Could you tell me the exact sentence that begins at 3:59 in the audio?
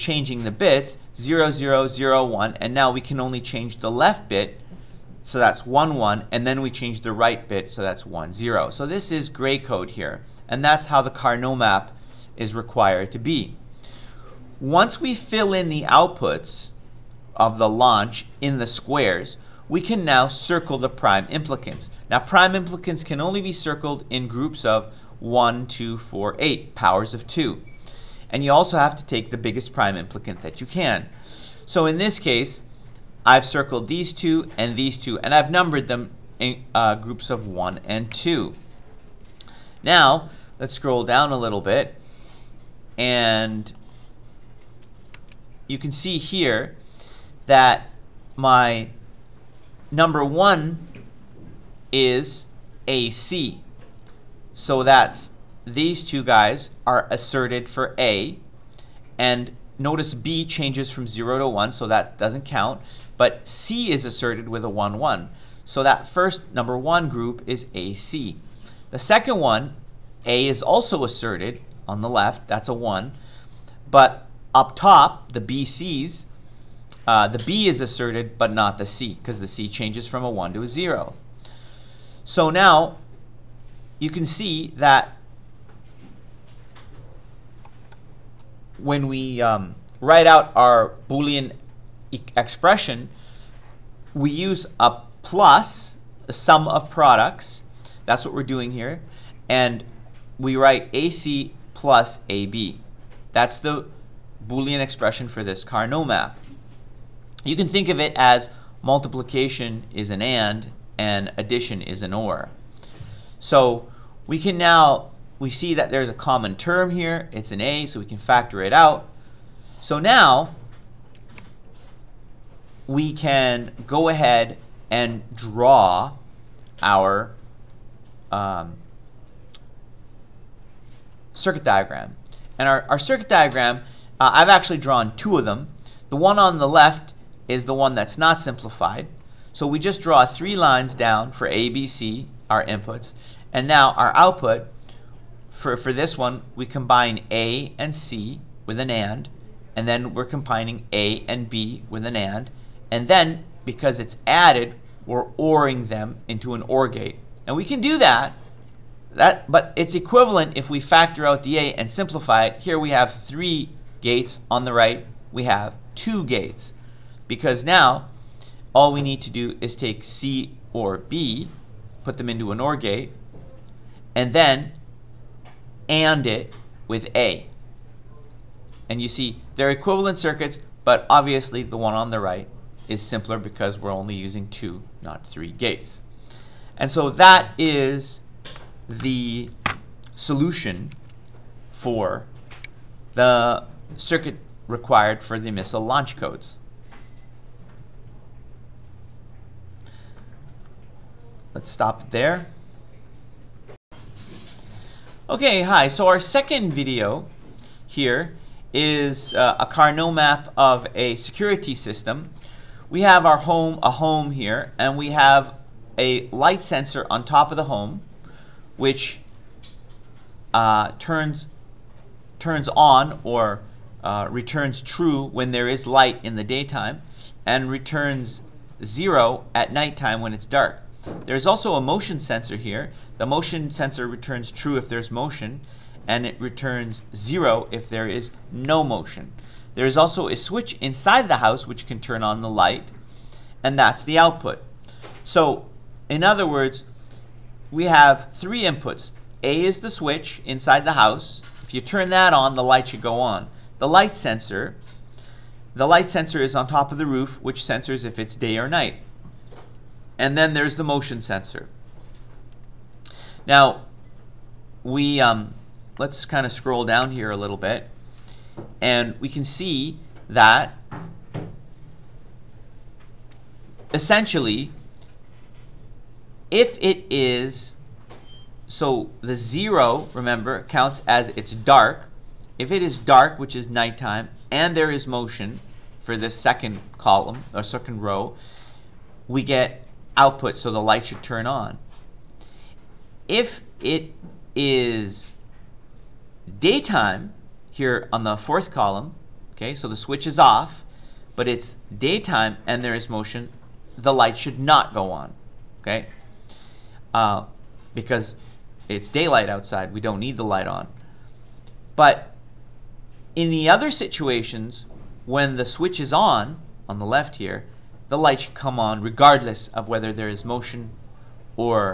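There is also a switch inside the house which can turn on the light, and that's the output.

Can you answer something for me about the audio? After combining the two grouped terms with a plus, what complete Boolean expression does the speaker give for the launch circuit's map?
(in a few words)
AC plus AB.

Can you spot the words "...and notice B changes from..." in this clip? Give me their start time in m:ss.
0:59.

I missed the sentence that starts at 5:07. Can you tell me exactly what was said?
Uh, because it's daylight outside, we don't need the light on.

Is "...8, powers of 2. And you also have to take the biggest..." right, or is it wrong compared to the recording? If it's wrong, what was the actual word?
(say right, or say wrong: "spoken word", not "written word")
right.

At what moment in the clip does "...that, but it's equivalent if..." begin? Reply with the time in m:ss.
2:39.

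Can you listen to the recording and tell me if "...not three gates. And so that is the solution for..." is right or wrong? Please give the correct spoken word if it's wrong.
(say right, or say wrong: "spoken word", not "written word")
right.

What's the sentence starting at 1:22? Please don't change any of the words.
So now you can see that when we um, write out our Boolean expression, we use a plus, a sum of products.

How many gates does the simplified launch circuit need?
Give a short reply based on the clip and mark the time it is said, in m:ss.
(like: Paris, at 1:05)
2, at 2:45.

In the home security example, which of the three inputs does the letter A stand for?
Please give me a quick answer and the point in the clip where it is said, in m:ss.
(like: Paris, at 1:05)
The switch inside the house, at 4:09.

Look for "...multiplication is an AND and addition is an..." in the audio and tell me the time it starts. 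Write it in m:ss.
1:48.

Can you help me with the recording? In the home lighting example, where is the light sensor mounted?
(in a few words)
On top of the home.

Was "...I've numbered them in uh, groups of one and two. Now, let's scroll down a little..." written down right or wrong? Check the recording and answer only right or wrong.
right.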